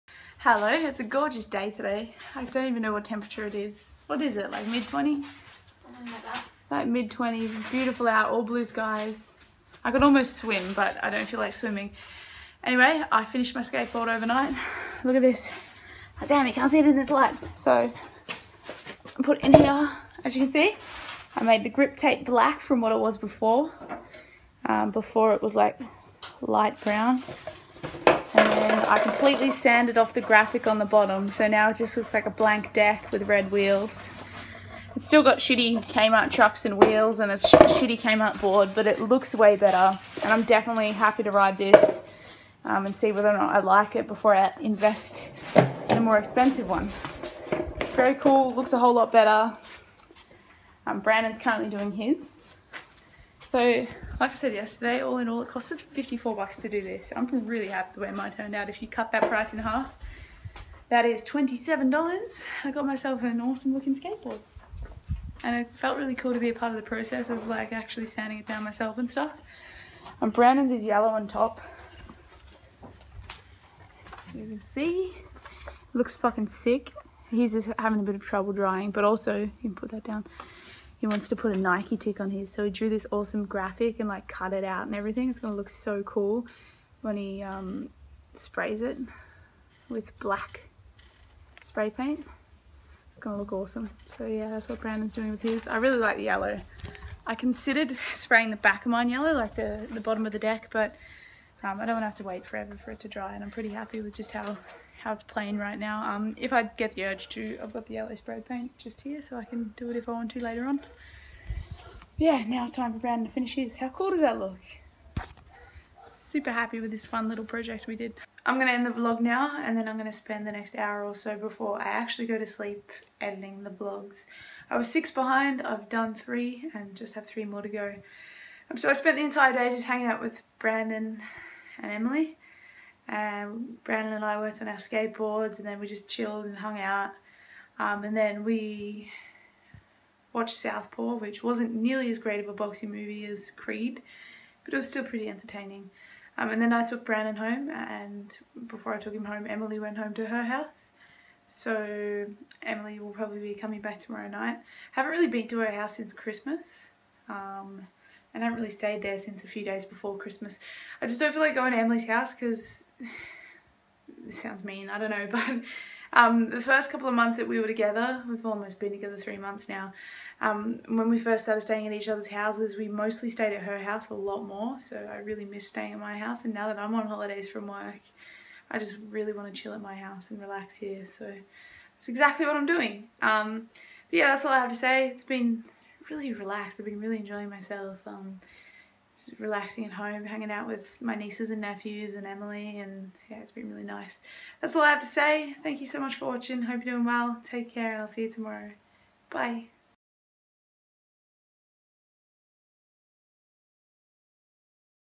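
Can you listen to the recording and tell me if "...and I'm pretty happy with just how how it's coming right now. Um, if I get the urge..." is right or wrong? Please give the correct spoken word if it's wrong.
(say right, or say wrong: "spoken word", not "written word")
wrong: "playing", not "coming".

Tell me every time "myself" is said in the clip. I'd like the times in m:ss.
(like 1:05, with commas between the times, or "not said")
1:02, 1:08, 3:07.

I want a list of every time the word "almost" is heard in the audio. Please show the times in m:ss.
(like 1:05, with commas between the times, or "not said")
0:10, 2:48.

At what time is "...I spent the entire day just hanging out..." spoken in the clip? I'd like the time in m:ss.
2:08.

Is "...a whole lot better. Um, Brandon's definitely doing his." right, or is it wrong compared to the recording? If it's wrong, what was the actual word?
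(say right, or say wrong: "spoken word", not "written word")
wrong: "currently", not "definitely".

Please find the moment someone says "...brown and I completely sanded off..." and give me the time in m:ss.
0:26.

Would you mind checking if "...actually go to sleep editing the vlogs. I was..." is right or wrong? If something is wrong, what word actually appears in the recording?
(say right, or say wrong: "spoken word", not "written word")
right.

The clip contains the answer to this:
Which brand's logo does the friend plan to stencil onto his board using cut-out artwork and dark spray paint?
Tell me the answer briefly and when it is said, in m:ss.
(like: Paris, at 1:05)
Nike, at 1:21.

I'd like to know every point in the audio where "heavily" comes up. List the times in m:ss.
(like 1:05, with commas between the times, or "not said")
not said.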